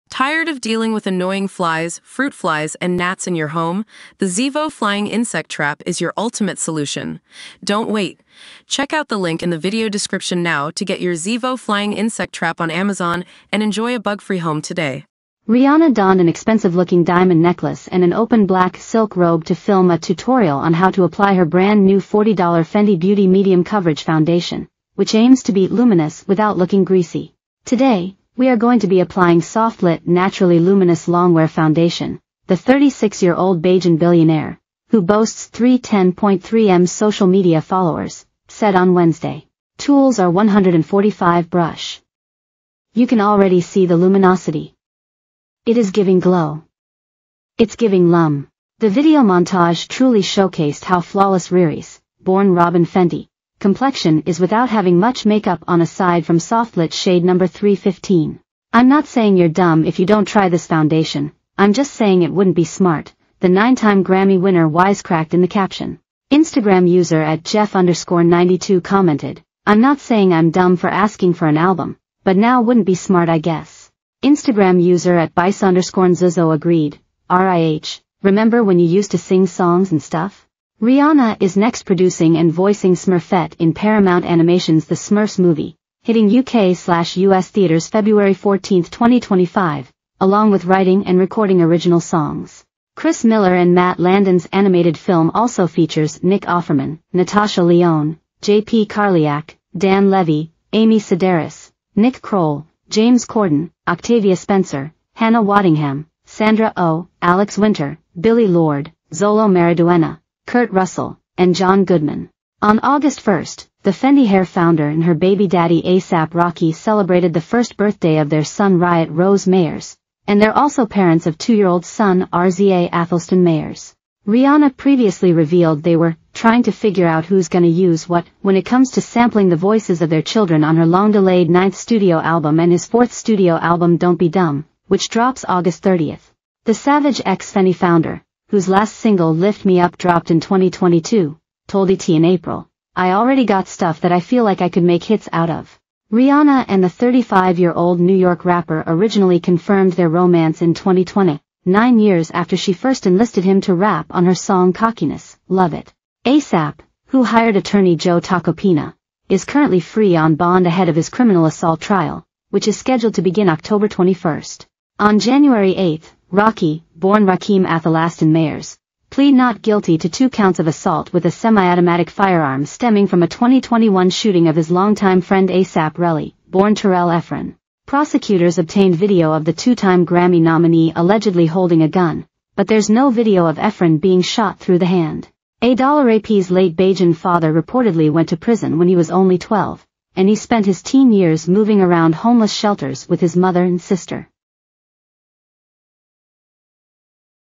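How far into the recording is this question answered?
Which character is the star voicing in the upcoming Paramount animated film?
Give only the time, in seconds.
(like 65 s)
82 s.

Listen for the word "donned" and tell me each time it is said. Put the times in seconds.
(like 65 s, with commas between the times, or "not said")
15 s.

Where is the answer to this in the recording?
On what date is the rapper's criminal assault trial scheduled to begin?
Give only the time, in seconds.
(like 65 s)
163 s.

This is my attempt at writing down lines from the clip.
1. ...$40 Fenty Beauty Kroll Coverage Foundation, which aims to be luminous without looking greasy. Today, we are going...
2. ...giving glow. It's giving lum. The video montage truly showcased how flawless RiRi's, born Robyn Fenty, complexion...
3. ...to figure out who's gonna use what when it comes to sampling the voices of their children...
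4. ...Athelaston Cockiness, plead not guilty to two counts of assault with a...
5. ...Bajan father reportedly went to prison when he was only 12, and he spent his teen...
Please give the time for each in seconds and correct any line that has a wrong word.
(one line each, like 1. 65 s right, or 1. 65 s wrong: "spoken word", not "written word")
1. 21 s wrong: "Medium", not "Kroll"
2. 45 s right
3. 126 s right
4. 167 s wrong: "Mayers", not "Cockiness"
5. 186 s right.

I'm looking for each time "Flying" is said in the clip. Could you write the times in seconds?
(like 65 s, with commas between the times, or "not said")
4 s, 11 s.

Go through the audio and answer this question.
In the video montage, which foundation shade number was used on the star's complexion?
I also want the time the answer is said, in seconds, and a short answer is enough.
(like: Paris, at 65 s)
315, at 57 s.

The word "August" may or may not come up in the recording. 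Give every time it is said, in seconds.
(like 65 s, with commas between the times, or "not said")
112 s, 135 s.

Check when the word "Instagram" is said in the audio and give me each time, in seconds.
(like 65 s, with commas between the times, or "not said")
66 s, 74 s.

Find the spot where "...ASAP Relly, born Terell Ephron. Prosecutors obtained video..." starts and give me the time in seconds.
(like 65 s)
175 s.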